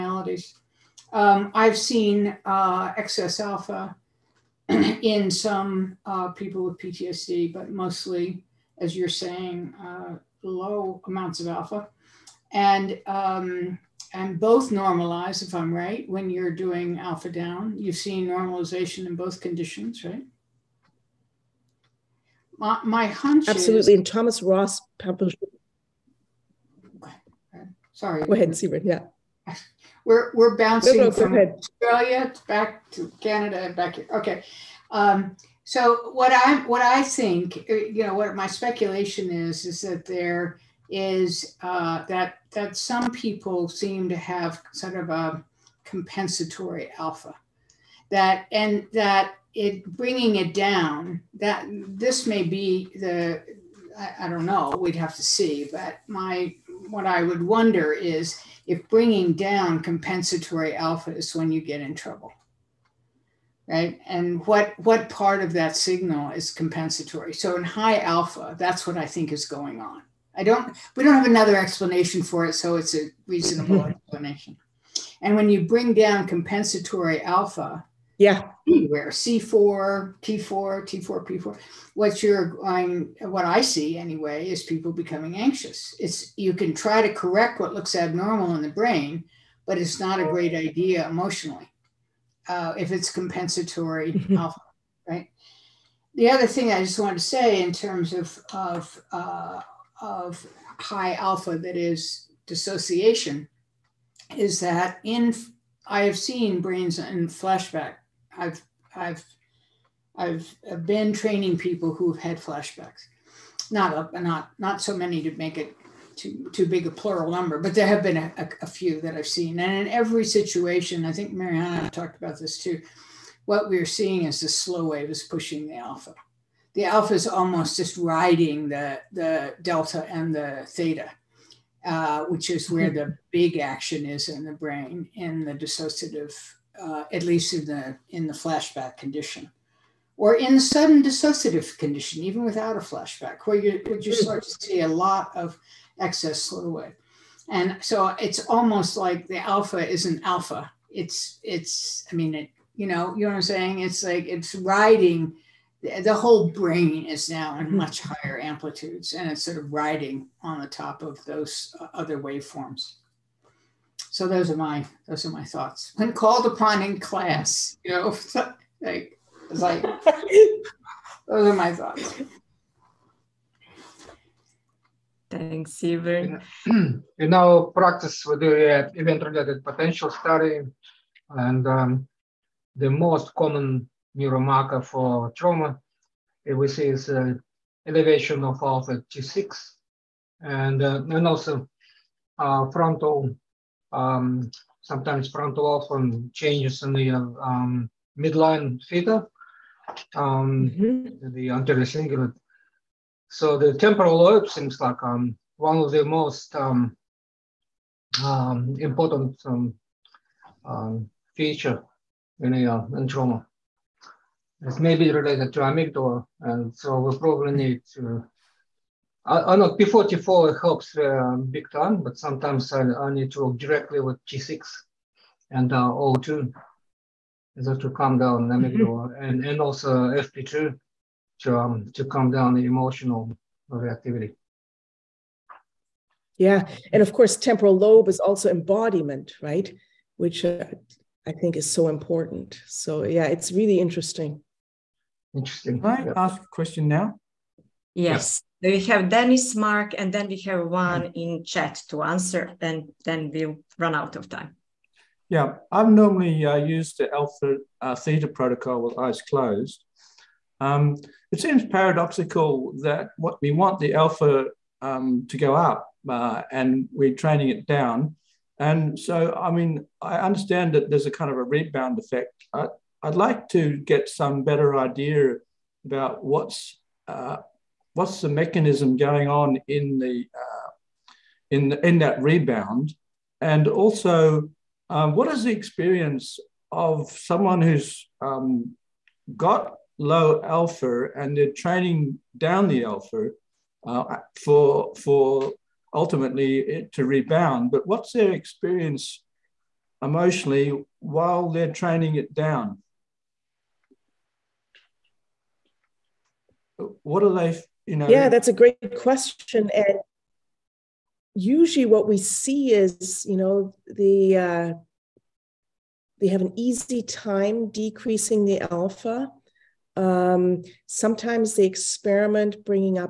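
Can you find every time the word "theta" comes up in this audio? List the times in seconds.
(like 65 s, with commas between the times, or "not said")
130 s, 198 s, 257 s.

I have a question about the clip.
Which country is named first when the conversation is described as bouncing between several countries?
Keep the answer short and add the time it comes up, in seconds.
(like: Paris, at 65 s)
Australia, at 31 s.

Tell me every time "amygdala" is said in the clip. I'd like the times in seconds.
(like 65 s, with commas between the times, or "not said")
215 s, 228 s.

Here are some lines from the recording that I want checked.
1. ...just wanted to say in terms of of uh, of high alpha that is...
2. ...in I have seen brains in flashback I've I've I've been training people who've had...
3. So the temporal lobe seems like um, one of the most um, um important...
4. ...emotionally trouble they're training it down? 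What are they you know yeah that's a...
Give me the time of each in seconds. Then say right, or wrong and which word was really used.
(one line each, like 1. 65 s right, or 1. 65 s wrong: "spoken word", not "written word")
1. 96 s right
2. 105 s right
3. 203 s right
4. 300 s wrong: "while", not "trouble".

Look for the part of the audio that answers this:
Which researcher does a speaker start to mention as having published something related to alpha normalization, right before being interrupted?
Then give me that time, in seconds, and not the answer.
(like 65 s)
24 s.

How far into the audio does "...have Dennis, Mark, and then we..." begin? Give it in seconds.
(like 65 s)
248 s.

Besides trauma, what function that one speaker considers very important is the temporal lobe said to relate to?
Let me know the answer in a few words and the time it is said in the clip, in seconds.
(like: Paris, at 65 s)
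embodiment, at 238 s.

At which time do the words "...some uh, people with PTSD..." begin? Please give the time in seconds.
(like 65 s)
5 s.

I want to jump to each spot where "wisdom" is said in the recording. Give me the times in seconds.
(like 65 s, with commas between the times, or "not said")
not said.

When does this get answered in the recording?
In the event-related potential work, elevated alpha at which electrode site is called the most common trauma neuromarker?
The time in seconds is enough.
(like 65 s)
189 s.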